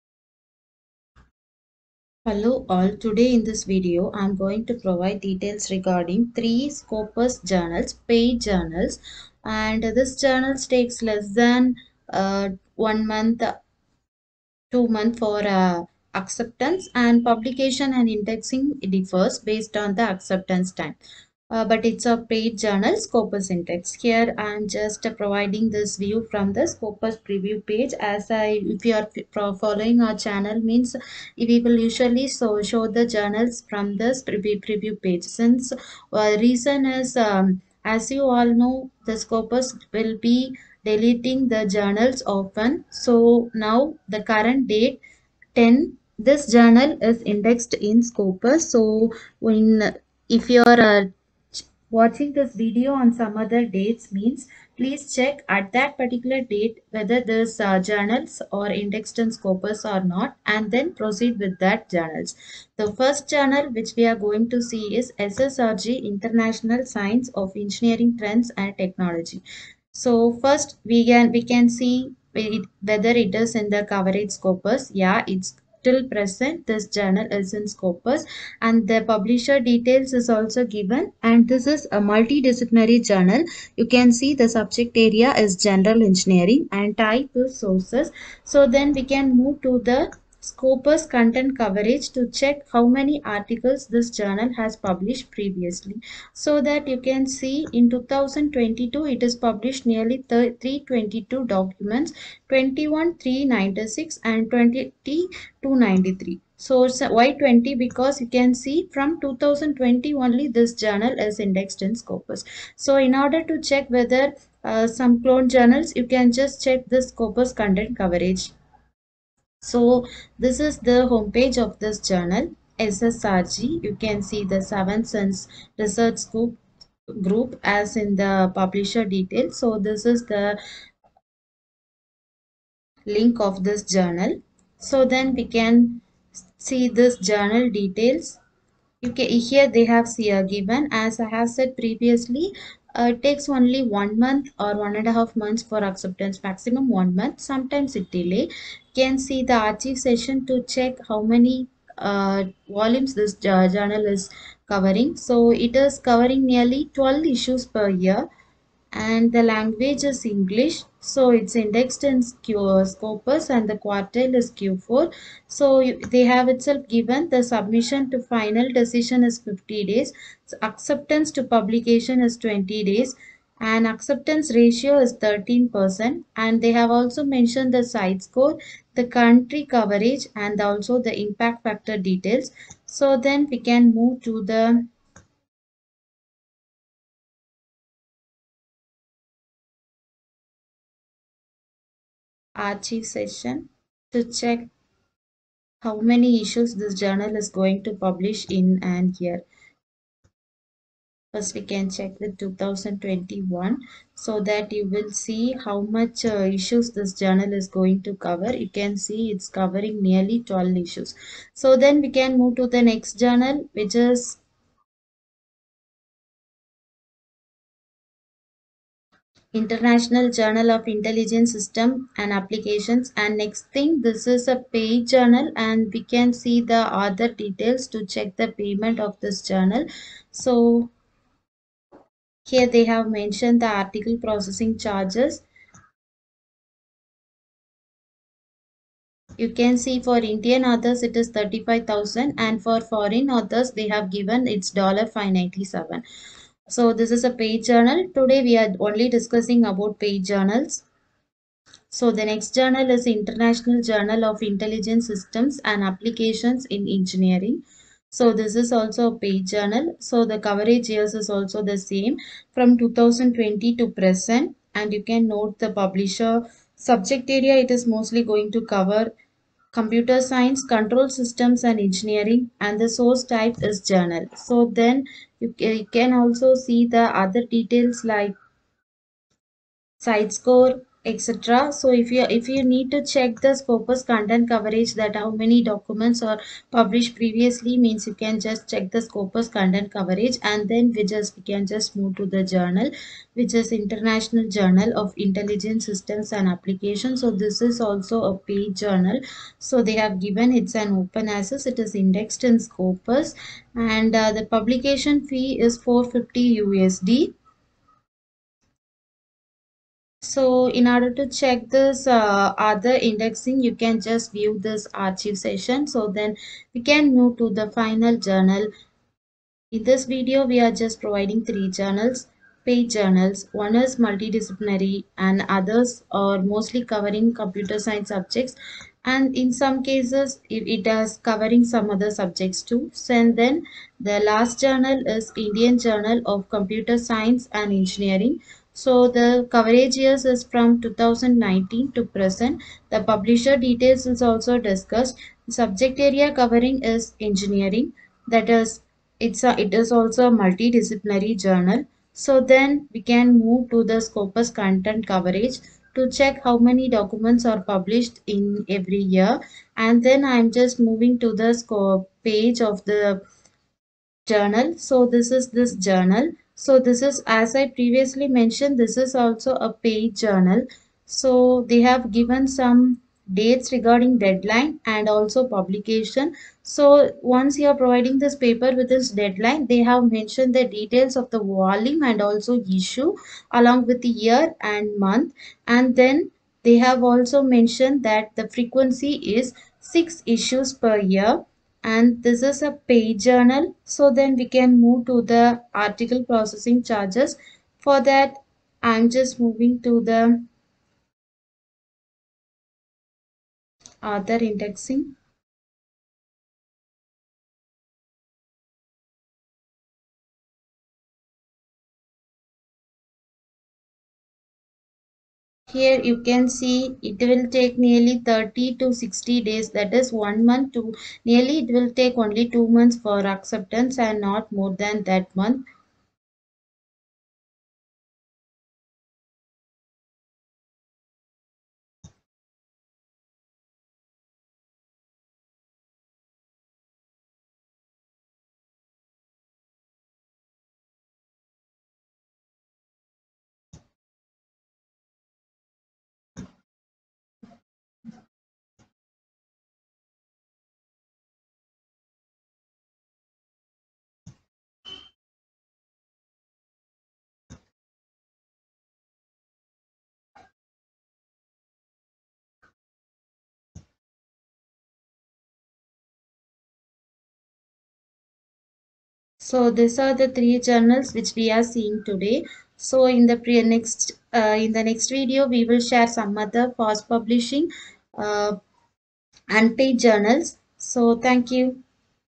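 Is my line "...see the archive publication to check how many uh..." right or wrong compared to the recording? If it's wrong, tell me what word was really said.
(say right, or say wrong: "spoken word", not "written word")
wrong: "session", not "publication".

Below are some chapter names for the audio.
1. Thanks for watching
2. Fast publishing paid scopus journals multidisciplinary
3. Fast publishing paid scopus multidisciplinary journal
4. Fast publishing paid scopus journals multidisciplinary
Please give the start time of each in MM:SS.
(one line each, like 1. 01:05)
1. 07:30
2. 03:55
3. 01:00
4. 05:26.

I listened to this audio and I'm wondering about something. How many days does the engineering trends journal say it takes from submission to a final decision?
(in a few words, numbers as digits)
50 days.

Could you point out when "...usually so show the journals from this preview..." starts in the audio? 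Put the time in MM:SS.
00:31.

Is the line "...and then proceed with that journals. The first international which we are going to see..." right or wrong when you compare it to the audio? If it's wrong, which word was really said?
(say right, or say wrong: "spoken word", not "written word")
wrong: "journal", not "international".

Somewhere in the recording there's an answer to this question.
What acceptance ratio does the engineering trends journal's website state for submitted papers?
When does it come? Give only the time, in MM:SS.
02:55.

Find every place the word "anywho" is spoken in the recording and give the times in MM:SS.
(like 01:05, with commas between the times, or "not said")
not said.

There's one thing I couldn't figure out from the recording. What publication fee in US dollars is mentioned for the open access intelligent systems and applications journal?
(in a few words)
450 USD.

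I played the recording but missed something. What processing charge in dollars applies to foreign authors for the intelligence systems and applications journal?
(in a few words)
$597.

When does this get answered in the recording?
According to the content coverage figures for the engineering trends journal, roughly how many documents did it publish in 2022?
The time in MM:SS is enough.
01:40.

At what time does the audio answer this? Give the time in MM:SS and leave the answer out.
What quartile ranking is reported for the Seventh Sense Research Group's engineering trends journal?
02:44.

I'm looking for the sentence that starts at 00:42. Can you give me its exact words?
So now the current date 10 this journal is indexed in Scopus.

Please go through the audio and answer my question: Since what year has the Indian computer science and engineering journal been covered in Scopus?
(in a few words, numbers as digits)
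2019.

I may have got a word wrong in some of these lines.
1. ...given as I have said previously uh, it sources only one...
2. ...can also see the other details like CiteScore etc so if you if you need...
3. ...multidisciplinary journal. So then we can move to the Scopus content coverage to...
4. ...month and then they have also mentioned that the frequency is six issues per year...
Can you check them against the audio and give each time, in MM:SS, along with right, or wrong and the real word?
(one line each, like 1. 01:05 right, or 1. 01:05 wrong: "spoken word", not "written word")
1. 02:20 wrong: "takes", not "sources"
2. 04:35 right
3. 05:50 right
4. 06:25 right.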